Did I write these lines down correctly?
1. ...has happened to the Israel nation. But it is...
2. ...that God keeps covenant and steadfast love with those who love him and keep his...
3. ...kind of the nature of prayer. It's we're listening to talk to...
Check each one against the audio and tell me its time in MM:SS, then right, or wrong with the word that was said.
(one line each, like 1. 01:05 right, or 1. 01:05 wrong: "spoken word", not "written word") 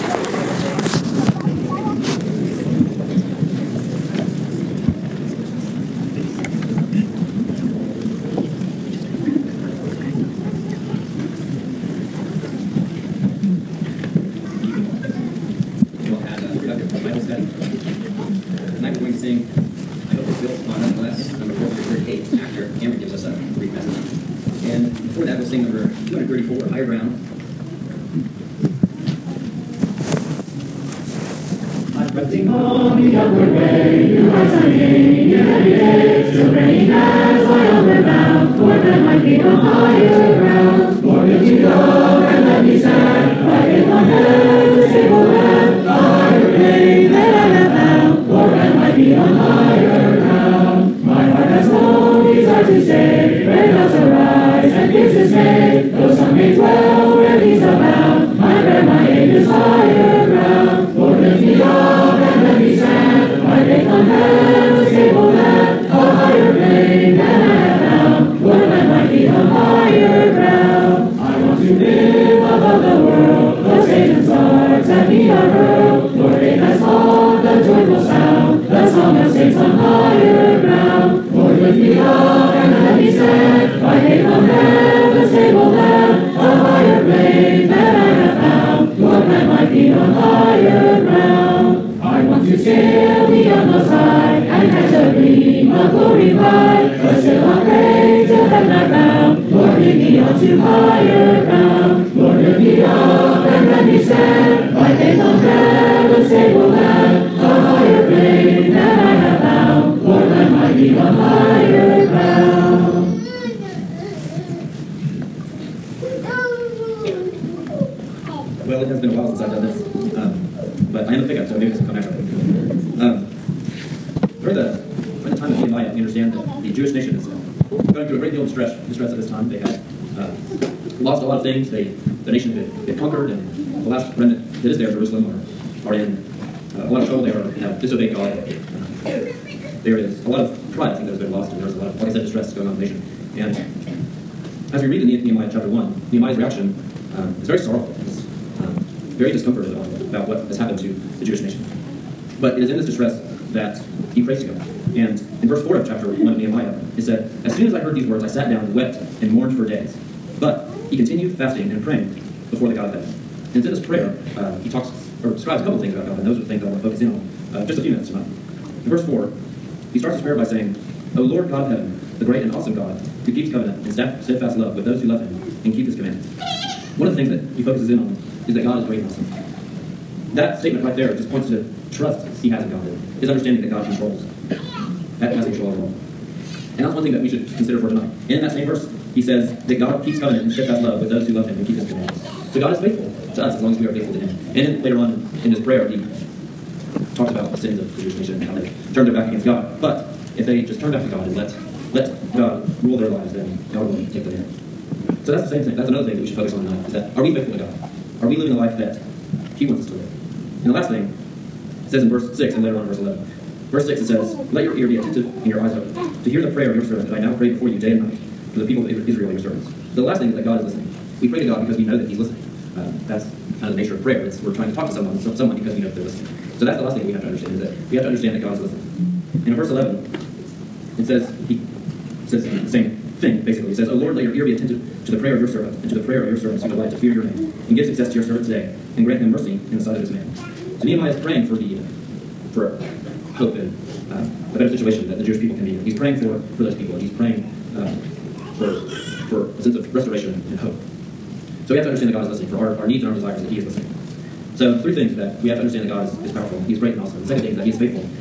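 1. 02:30 wrong: "Jewish", not "Israel"
2. 03:09 right
3. 03:43 wrong: "trying", not "listening".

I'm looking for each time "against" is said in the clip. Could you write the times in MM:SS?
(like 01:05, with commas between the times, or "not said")
03:19.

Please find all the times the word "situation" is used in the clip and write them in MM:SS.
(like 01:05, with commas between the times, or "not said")
04:04.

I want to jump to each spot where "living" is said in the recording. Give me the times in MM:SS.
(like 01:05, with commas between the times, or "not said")
03:28.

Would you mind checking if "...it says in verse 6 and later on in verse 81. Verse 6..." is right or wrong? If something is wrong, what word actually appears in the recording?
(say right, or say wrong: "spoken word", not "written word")
wrong: "11", not "81".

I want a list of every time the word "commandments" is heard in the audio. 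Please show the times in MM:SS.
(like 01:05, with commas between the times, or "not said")
02:55, 03:11.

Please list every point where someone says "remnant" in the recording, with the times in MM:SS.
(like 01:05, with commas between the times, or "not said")
02:14.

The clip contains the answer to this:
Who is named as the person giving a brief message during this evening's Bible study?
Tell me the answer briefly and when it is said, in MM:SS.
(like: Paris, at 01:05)
Cameron, at 00:22.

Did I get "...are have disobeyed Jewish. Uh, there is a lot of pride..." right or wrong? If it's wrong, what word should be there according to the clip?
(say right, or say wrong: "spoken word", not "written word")
wrong: "God", not "Jewish".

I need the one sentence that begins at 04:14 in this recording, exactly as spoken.
So the three things that we have to understand that God is, is powerful, He is great and awesome.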